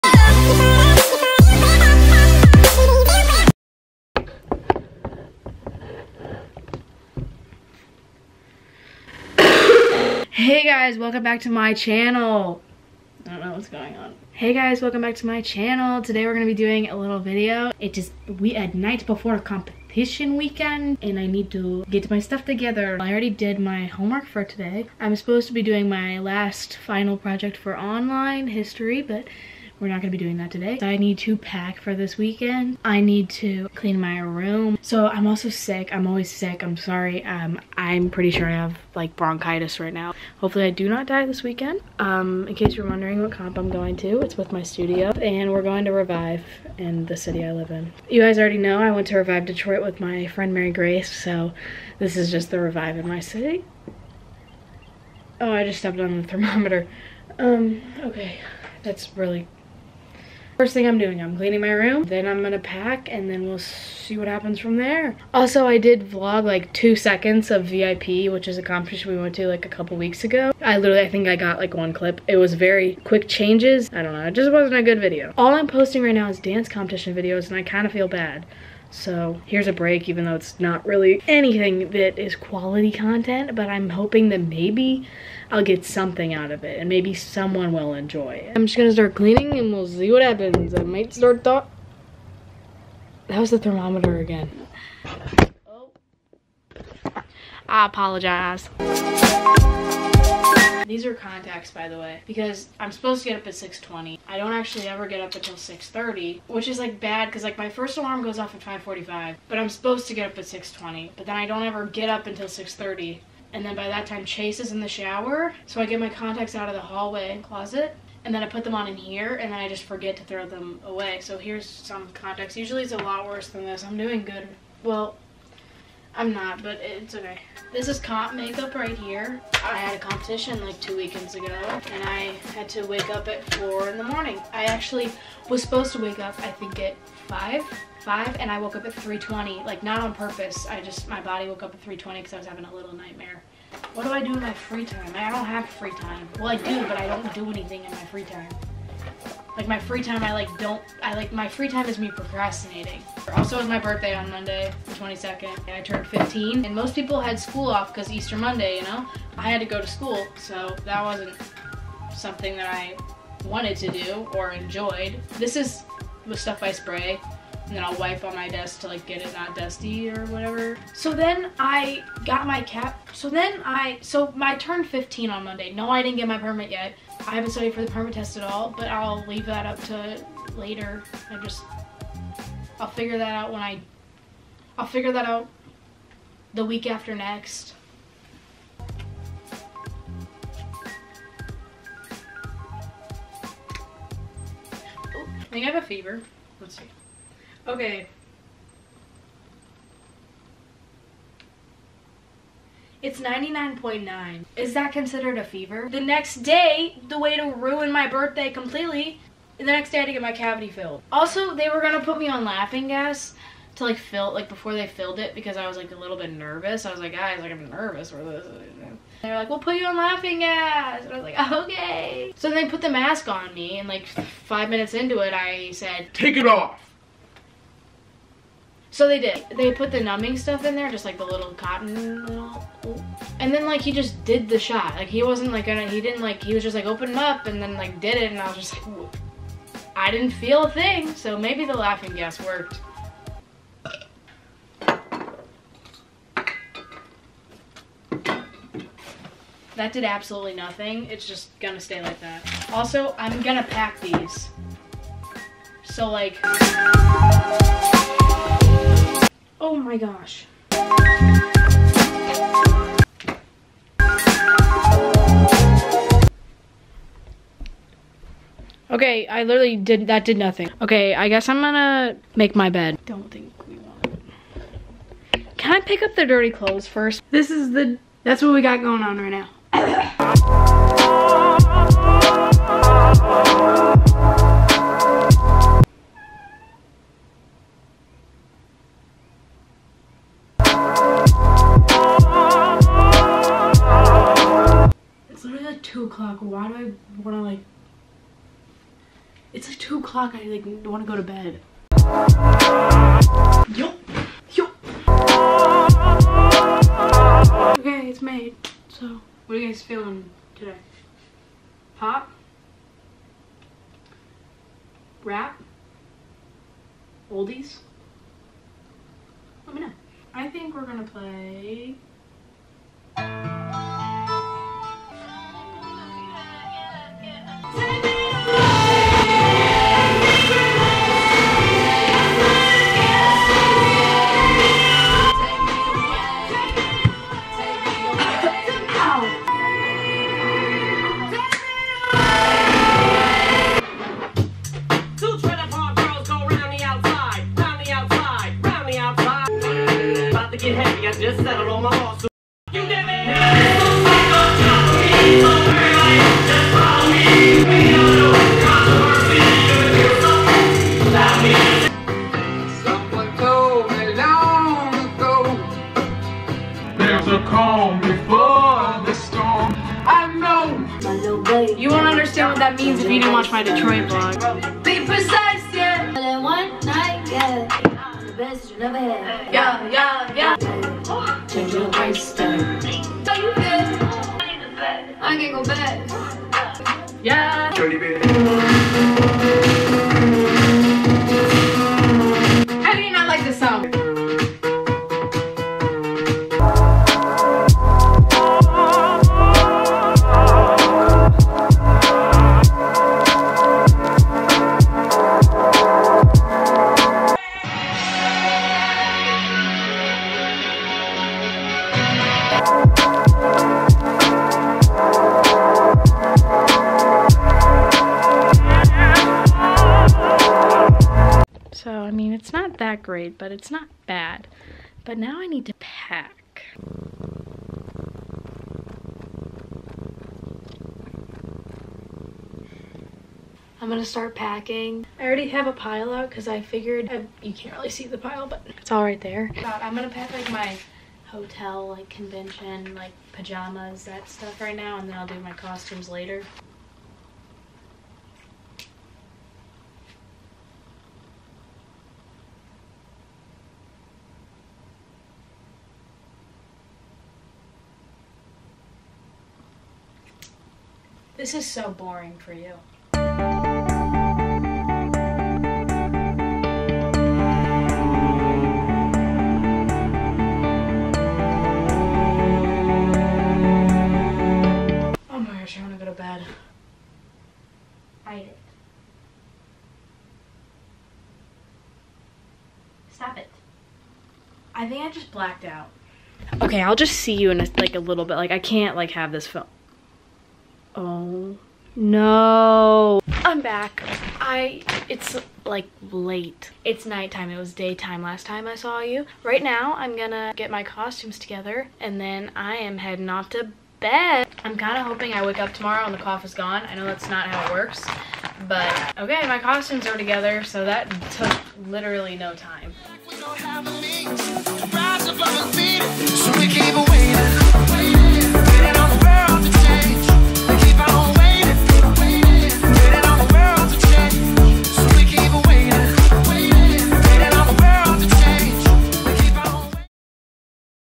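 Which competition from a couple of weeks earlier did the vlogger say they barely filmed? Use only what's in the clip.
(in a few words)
VIP.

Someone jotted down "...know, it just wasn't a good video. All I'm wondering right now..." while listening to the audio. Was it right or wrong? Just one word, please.
wrong.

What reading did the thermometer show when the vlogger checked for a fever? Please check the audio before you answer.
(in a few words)
99.9.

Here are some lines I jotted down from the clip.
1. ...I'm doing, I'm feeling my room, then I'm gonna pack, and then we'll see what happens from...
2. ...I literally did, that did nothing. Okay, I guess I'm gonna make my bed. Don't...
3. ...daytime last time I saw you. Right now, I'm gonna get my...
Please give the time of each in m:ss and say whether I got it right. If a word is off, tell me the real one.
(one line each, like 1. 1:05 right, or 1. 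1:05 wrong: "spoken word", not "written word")
1. 1:00 wrong: "cleaning", not "feeling"
2. 4:29 right
3. 8:17 right.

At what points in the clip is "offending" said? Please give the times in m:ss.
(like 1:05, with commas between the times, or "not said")
not said.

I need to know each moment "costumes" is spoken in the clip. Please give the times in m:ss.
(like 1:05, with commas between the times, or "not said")
7:25, 8:20, 8:29.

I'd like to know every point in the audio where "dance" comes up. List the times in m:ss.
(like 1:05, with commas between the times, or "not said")
1:16.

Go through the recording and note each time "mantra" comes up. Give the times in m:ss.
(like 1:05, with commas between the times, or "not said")
not said.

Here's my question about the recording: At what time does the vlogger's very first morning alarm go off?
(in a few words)
5:45.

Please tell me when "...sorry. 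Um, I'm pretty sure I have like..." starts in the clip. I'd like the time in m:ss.
0:36.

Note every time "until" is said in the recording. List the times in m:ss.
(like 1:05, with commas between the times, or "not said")
1:45, 1:52.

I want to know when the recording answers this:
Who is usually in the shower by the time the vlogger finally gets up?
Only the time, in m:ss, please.
1:54.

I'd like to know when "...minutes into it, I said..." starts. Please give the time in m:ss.
3:44.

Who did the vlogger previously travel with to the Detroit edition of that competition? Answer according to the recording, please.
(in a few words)
Mary Grace.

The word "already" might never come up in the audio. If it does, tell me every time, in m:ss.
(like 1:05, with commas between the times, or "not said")
0:23, 0:48, 7:15.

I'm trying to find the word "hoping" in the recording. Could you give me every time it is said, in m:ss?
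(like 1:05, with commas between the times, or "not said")
1:23, 8:25.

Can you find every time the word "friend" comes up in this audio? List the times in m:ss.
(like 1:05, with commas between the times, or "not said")
0:50.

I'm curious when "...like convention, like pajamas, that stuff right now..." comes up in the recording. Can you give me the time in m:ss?
7:21.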